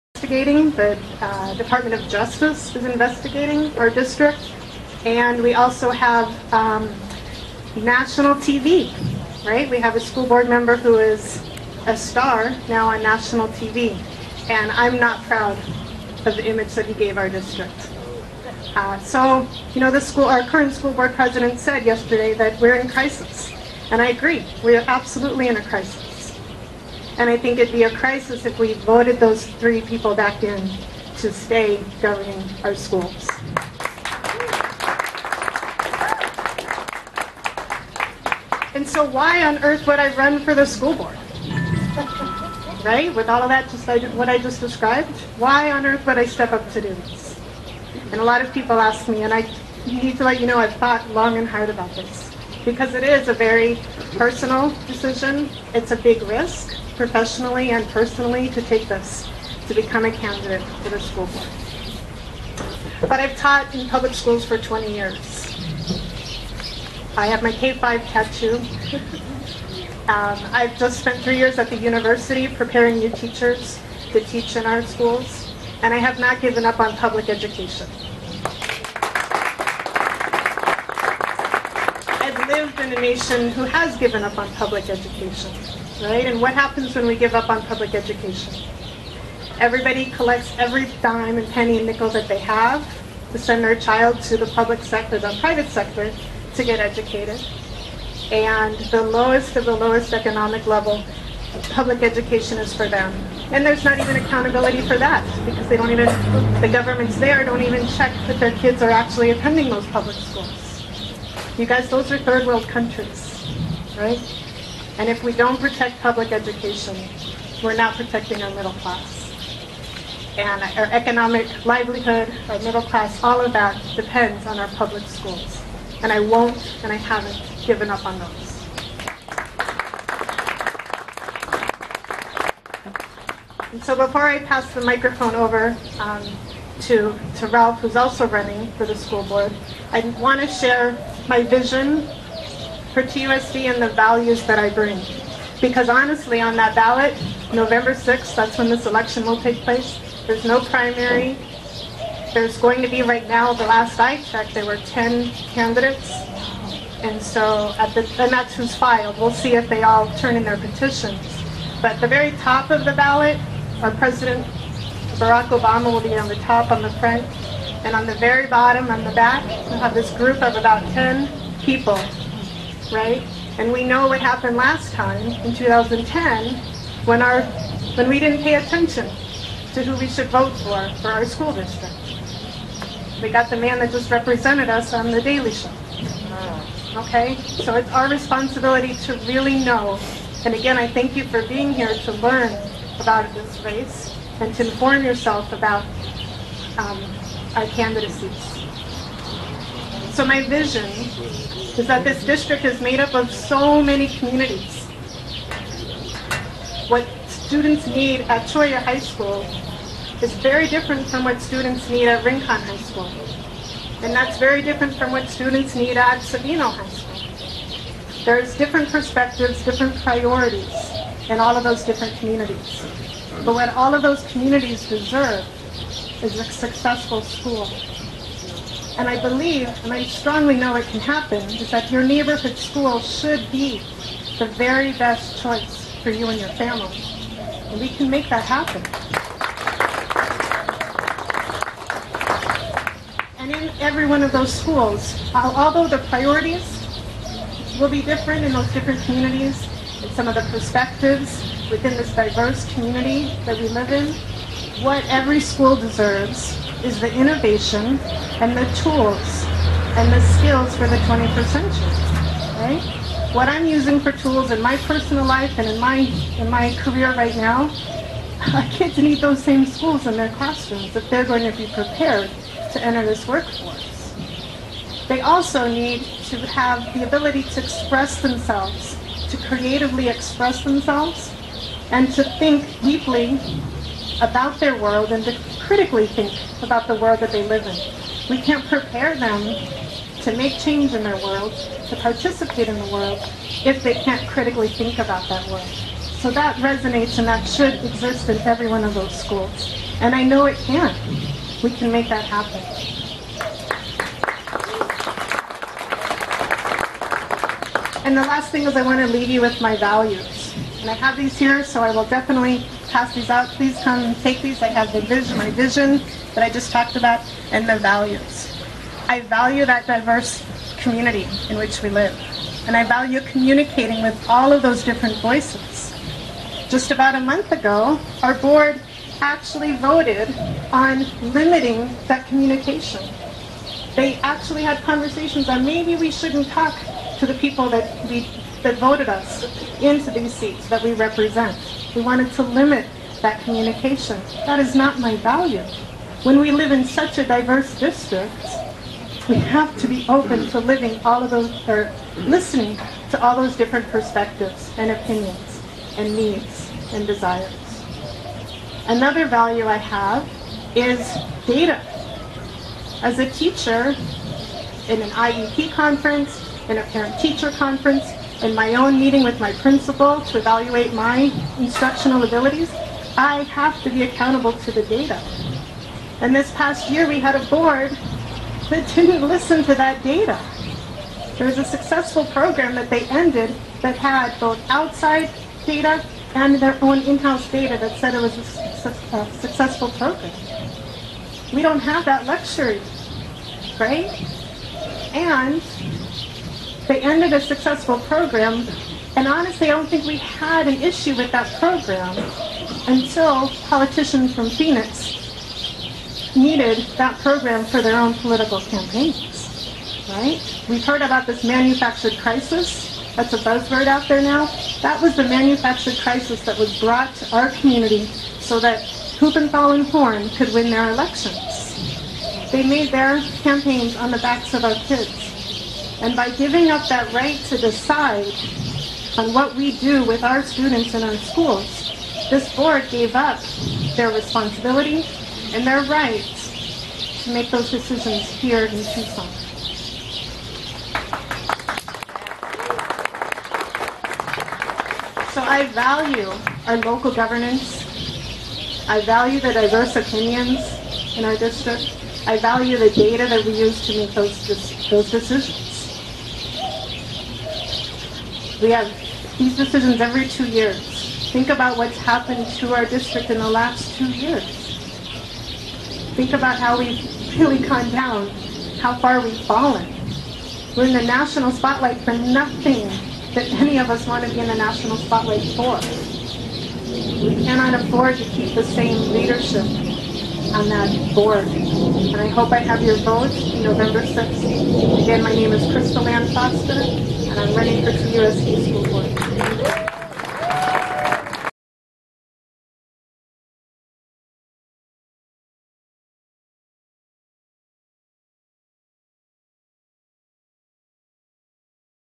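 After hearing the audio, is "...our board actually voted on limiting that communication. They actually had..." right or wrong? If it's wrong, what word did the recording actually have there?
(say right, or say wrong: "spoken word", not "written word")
right.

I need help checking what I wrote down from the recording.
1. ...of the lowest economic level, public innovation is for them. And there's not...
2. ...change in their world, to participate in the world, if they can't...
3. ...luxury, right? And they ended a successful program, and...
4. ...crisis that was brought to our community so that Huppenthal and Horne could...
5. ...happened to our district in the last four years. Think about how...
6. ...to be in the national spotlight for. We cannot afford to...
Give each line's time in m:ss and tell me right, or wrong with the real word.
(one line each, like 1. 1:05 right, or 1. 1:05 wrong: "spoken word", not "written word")
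1. 1:39 wrong: "education", not "innovation"
2. 4:50 right
3. 6:32 right
4. 6:56 right
5. 7:41 wrong: "two", not "four"
6. 7:54 right.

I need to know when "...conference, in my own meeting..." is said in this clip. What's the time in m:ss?
6:07.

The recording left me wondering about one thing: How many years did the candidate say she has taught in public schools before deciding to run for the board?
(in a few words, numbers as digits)
20.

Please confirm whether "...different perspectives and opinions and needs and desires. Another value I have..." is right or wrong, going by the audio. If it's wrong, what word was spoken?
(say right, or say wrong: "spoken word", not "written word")
right.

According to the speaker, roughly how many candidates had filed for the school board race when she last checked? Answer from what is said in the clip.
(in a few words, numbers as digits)
10.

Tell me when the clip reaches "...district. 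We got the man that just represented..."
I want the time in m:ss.
3:01.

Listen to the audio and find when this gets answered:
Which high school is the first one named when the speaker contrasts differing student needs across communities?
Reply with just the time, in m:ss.
3:28.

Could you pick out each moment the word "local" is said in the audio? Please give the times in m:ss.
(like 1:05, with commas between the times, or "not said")
7:26.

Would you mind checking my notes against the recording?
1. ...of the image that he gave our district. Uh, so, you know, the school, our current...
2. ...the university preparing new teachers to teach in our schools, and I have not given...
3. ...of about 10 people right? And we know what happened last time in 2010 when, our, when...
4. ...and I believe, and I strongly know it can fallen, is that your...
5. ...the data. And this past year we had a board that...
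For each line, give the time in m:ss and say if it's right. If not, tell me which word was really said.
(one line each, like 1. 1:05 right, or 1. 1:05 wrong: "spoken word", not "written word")
1. 0:16 right
2. 1:11 right
3. 2:50 right
4. 3:48 wrong: "happen", not "fallen"
5. 6:14 right.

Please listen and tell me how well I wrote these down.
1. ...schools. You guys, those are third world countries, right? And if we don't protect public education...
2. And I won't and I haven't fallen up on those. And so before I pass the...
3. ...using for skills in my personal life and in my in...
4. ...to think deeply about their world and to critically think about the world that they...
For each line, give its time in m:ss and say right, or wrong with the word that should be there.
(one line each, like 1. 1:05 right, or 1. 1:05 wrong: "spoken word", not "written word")
1. 1:50 right
2. 2:06 wrong: "given", not "fallen"
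3. 4:23 wrong: "tools", not "skills"
4. 4:42 right.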